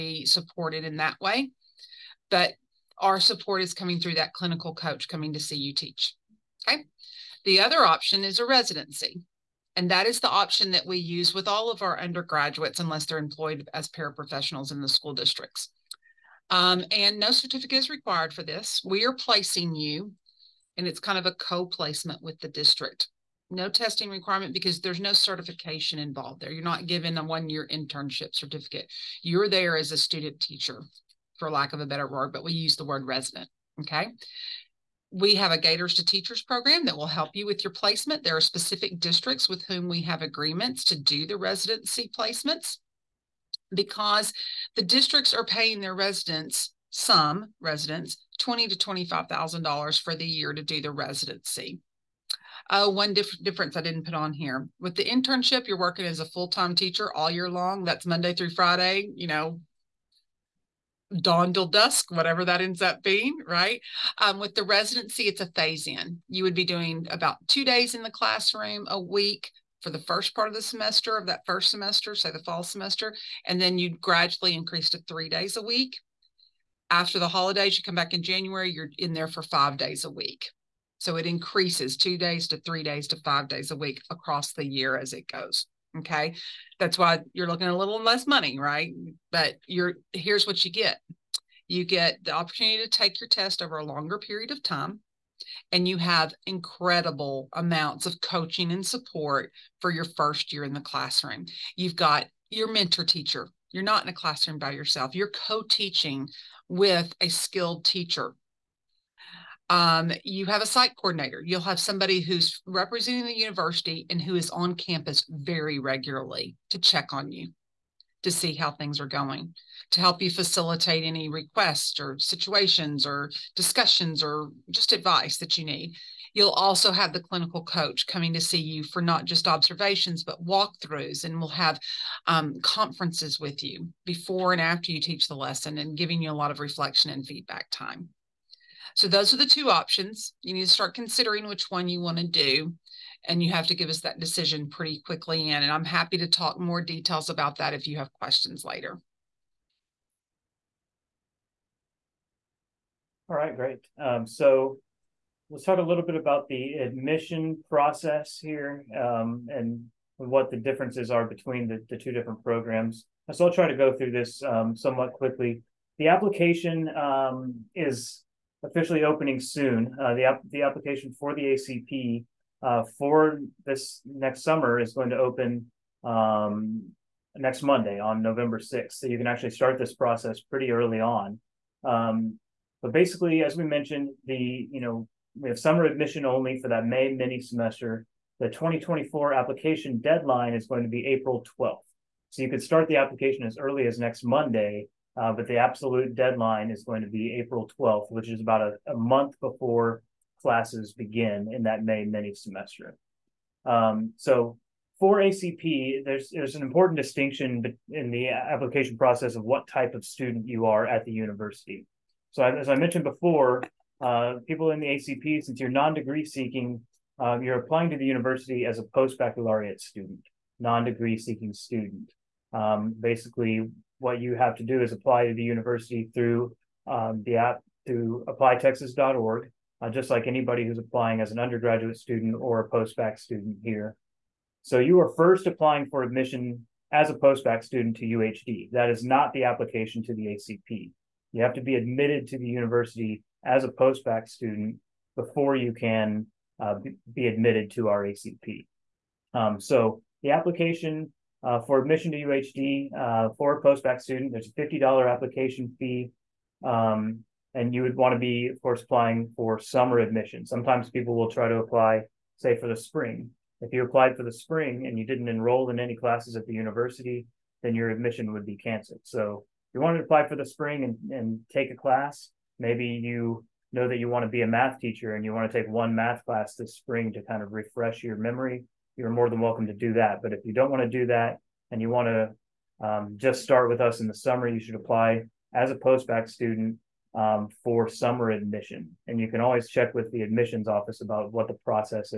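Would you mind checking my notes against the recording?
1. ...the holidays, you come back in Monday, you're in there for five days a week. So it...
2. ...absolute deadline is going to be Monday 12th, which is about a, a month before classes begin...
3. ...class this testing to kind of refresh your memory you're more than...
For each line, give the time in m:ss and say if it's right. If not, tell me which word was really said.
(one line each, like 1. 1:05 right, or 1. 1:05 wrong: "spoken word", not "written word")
1. 1:17 wrong: "January", not "Monday"
2. 3:15 wrong: "April", not "Monday"
3. 4:36 wrong: "spring", not "testing".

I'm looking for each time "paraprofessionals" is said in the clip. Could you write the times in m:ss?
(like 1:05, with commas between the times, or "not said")
0:13.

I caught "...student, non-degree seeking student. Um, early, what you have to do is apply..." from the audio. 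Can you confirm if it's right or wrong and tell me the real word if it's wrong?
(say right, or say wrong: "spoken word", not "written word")
wrong: "basically", not "early".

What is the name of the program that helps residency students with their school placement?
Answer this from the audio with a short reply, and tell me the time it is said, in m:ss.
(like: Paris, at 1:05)
Gators to Teachers, at 0:35.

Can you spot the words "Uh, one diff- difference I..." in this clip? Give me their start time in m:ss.
0:52.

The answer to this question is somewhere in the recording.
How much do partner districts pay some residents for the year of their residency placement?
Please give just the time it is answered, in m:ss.
0:48.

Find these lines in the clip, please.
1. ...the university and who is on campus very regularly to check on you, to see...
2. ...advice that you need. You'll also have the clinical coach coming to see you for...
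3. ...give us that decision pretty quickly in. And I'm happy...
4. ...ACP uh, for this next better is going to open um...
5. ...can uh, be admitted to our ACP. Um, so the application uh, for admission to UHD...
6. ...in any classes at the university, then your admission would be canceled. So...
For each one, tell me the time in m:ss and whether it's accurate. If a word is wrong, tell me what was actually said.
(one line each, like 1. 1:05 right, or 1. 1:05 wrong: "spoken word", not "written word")
1. 1:53 right
2. 2:04 right
3. 2:23 right
4. 2:51 wrong: "summer", not "better"
5. 4:05 right
6. 4:25 right.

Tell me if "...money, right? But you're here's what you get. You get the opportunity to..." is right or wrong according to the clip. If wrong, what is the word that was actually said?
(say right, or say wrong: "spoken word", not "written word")
right.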